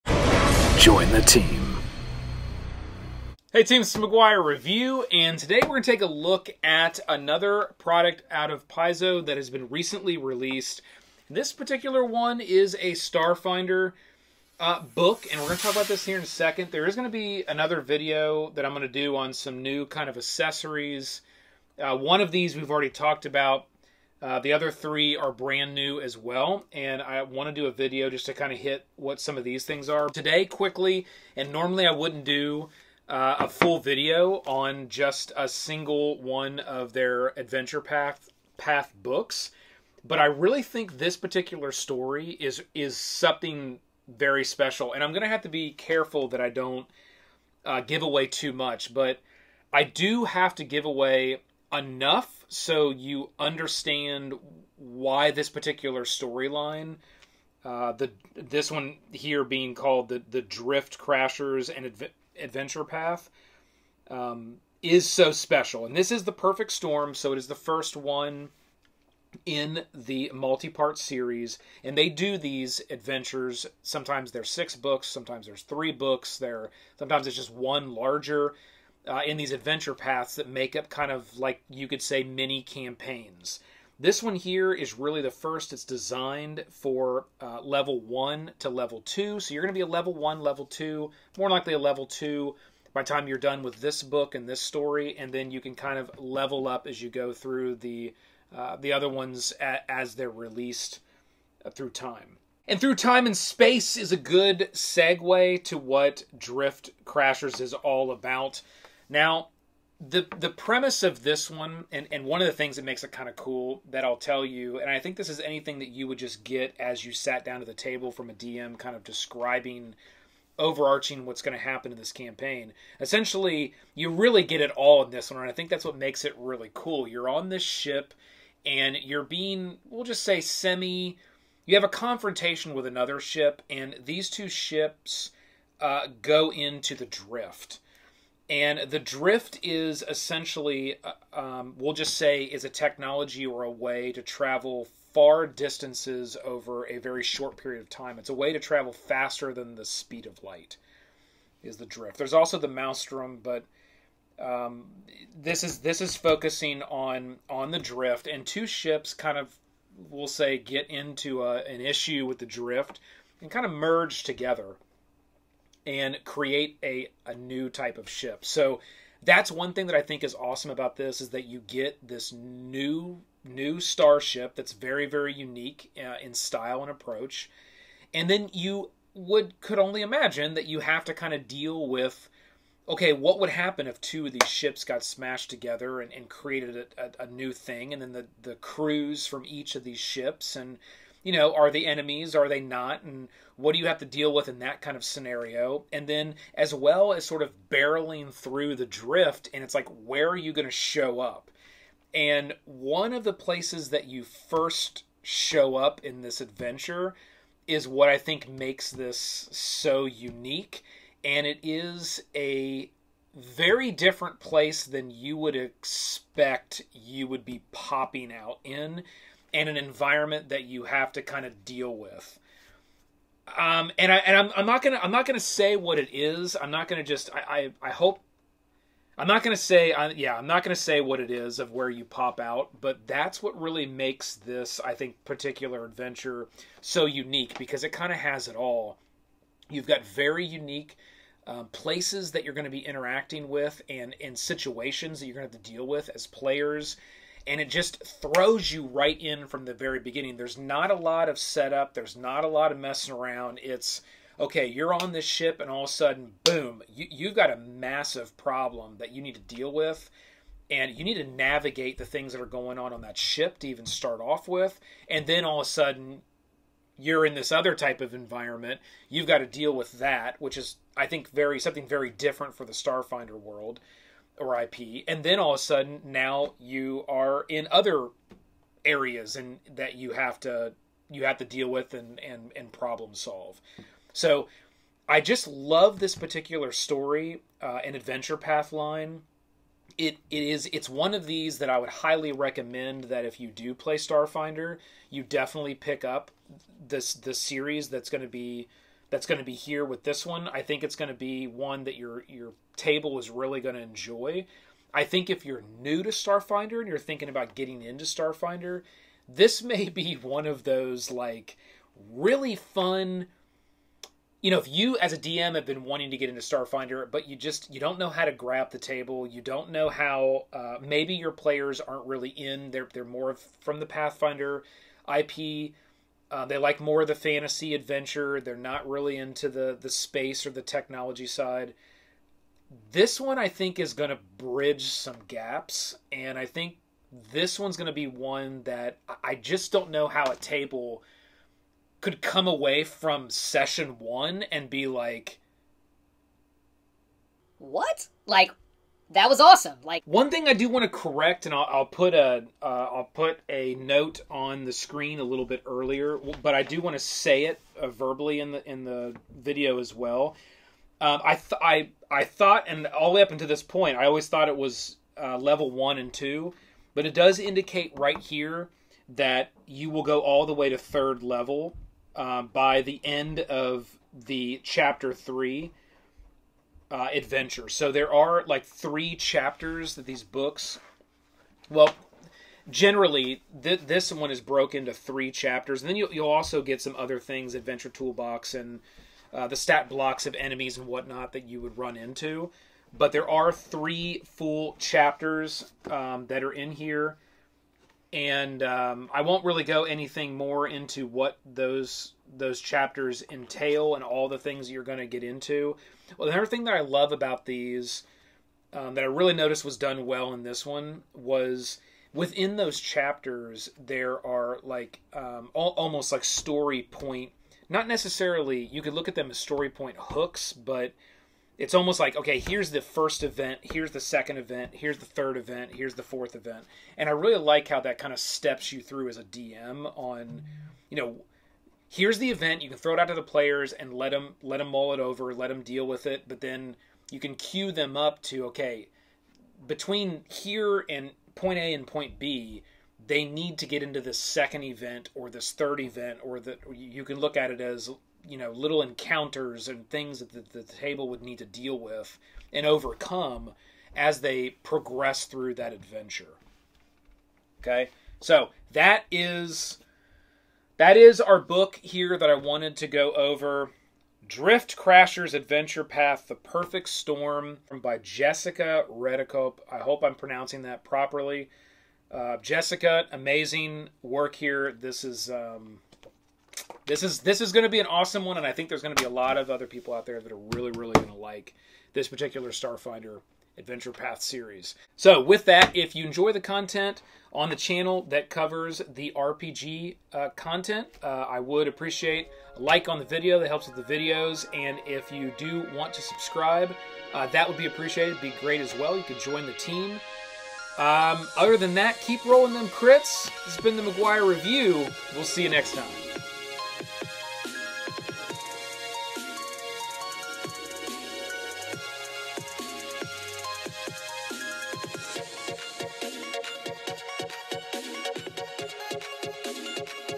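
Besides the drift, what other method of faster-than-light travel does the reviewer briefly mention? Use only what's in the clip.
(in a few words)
The maelstrom.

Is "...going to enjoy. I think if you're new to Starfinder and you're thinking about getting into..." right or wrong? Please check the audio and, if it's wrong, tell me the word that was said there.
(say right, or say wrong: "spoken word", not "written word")
right.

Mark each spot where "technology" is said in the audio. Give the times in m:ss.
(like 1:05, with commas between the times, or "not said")
2:22, 5:30.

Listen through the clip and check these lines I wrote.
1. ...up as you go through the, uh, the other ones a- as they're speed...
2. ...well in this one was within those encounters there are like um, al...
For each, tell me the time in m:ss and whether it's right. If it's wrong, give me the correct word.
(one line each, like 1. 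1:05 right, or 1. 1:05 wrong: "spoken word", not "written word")
1. 1:36 wrong: "released", not "speed"
2. 6:50 wrong: "chapters", not "encounters".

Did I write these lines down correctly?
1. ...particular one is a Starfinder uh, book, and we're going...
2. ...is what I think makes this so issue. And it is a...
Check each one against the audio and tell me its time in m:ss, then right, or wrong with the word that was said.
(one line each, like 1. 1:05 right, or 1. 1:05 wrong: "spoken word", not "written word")
1. 0:11 right
2. 3:27 wrong: "unique", not "issue".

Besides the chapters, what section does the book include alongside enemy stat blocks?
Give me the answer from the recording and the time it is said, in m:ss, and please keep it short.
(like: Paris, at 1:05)
Adventure toolbox, at 6:27.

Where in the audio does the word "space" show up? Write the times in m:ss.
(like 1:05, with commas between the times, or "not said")
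1:43, 5:29.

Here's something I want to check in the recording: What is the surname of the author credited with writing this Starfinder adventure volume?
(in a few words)
Redekop.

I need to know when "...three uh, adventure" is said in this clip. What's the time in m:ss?
6:15.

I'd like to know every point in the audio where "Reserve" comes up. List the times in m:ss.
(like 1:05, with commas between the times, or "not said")
not said.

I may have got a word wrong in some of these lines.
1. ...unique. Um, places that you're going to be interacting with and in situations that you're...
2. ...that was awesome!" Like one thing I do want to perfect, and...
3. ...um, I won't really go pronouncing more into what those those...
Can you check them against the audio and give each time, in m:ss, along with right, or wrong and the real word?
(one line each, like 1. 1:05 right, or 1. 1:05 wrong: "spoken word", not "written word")
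1. 4:00 right
2. 5:49 wrong: "correct", not "perfect"
3. 6:38 wrong: "anything", not "pronouncing".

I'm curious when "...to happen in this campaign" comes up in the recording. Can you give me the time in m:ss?
2:01.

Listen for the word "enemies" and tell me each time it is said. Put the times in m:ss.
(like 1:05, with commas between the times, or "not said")
3:11, 6:30.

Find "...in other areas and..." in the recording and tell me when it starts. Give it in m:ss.
4:37.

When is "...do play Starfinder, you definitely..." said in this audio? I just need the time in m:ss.
4:53.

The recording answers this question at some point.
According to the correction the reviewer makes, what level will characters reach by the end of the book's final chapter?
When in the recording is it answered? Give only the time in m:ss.
6:10.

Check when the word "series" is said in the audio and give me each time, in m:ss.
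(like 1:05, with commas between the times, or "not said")
1:10, 4:57, 8:04.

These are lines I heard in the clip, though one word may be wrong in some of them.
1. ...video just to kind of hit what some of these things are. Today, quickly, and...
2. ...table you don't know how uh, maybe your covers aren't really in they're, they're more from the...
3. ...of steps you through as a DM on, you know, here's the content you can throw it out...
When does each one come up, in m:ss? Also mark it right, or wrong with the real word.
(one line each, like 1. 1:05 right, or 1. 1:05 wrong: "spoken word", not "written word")
1. 0:27 right
2. 5:18 wrong: "players", not "covers"
3. 7:08 wrong: "event", not "content".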